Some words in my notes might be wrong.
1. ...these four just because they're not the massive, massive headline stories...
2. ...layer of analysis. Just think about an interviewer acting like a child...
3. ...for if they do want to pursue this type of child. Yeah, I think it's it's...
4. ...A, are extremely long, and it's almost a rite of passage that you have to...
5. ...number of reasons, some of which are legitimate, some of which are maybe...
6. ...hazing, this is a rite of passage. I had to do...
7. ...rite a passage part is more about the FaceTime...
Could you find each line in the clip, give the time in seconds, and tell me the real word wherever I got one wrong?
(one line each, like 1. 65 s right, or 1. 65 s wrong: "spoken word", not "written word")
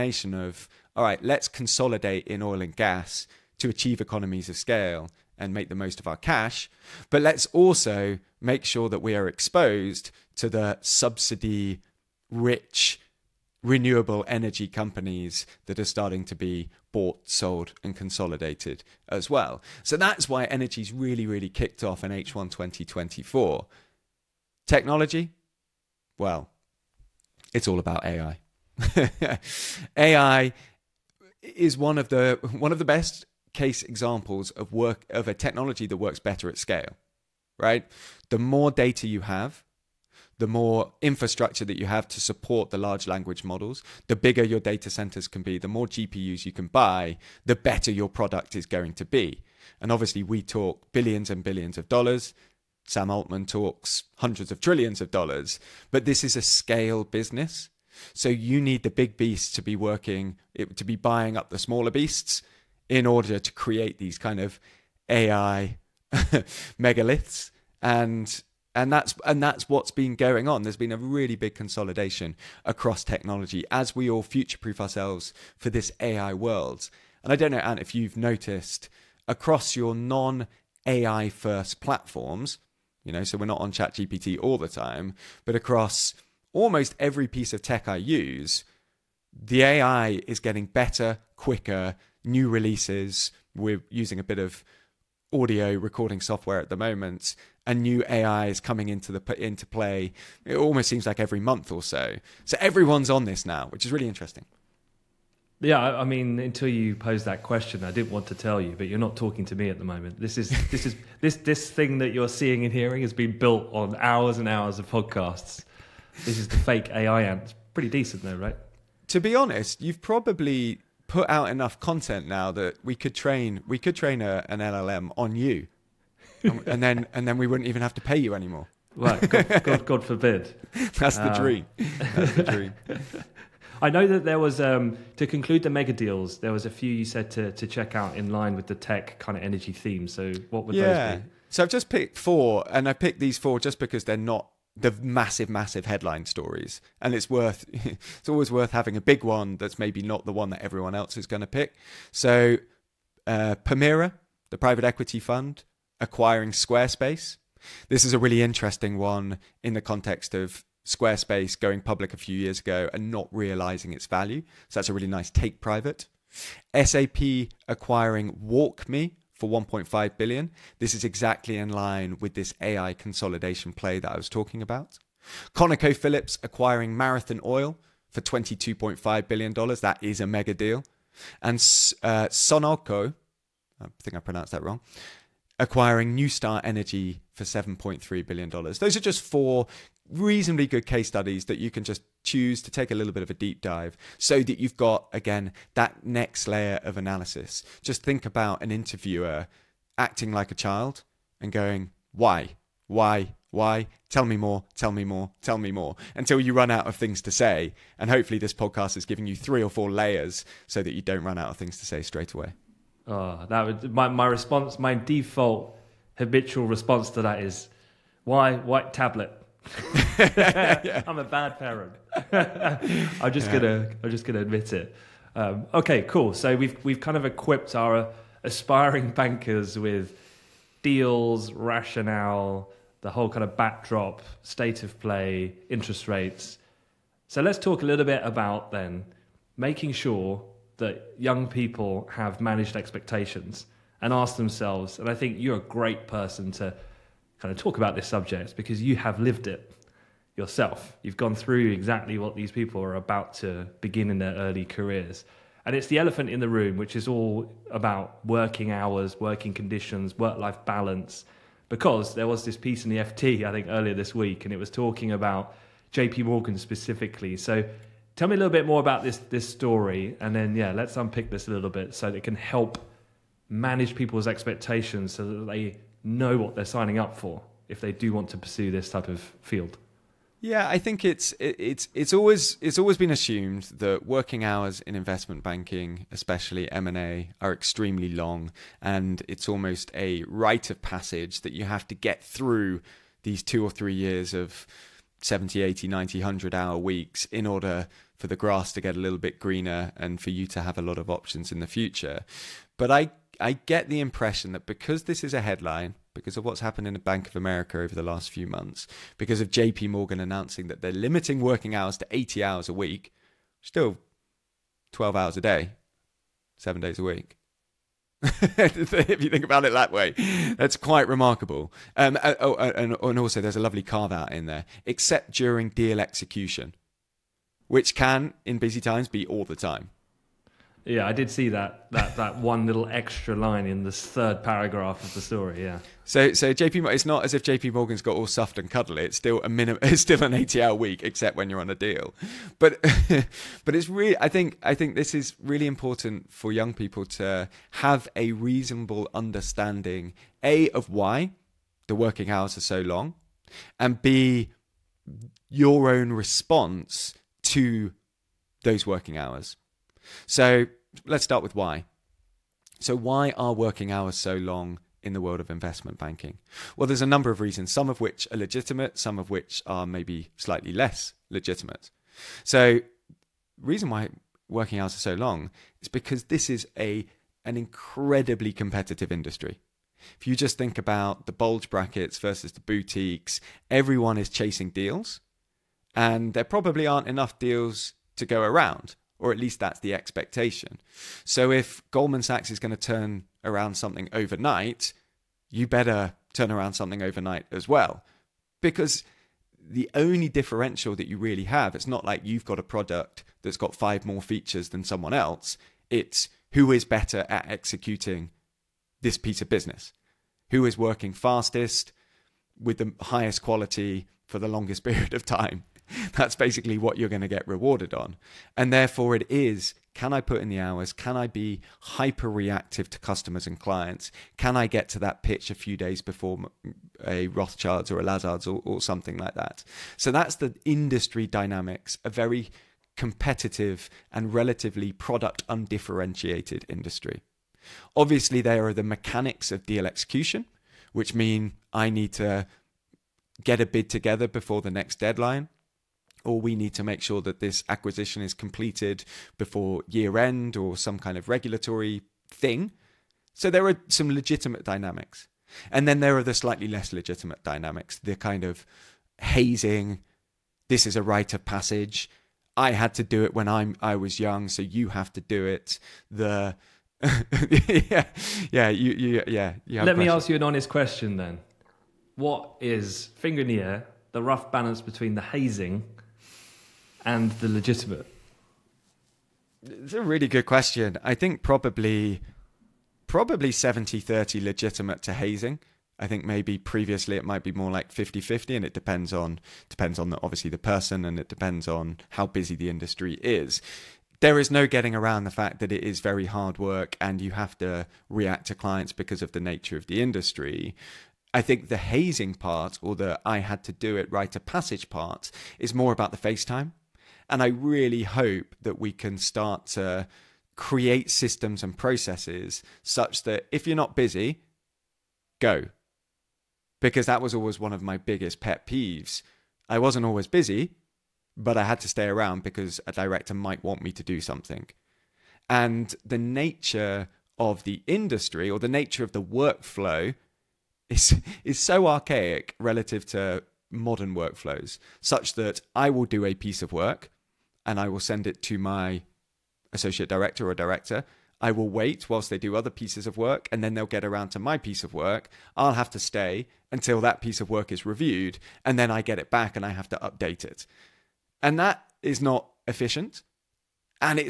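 1. 143 s right
2. 196 s right
3. 277 s wrong: "field", not "child"
4. 286 s right
5. 367 s right
6. 459 s right
7. 504 s right.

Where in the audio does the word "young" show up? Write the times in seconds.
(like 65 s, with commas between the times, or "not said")
241 s, 346 s, 464 s.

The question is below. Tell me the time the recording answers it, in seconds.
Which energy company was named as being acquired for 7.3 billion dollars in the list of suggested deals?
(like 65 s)
186 s.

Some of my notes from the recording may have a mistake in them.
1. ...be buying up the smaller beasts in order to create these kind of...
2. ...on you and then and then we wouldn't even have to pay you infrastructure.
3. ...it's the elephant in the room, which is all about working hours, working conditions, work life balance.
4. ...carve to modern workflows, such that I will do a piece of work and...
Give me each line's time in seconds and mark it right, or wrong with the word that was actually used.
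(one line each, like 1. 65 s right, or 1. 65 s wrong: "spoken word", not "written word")
1. 60 s right
2. 125 s wrong: "anymore", not "infrastructure"
3. 255 s right
4. 532 s wrong: "relative", not "carve".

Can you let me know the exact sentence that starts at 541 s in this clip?
I will wait whilst they do other pieces of work, and then they'll get around to my piece of work.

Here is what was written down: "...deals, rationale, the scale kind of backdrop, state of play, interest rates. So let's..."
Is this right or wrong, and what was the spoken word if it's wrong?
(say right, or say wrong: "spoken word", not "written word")
wrong: "whole", not "scale".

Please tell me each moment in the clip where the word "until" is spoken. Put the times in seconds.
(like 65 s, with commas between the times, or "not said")
106 s, 206 s, 546 s.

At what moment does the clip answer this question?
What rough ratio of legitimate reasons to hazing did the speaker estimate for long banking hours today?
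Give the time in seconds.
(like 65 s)
483 s.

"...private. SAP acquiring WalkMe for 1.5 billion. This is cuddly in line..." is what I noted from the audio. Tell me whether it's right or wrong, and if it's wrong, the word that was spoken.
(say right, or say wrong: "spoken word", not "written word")
wrong: "exactly", not "cuddly".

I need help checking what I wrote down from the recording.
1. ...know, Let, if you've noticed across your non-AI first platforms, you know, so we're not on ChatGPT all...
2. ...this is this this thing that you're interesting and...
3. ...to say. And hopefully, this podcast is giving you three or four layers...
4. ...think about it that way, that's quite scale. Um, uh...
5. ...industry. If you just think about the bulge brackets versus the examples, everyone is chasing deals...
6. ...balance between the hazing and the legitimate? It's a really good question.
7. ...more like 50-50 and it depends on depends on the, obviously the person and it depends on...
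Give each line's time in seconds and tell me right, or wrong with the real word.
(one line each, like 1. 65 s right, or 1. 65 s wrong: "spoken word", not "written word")
1. 77 s wrong: "Ant", not "Let"
2. 110 s wrong: "seeing", not "interesting"
3. 207 s right
4. 319 s wrong: "remarkable", not "scale"
5. 379 s wrong: "boutiques", not "examples"
6. 474 s right
7. 487 s right.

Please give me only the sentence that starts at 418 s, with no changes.
And therefore, it is can I put in the hours?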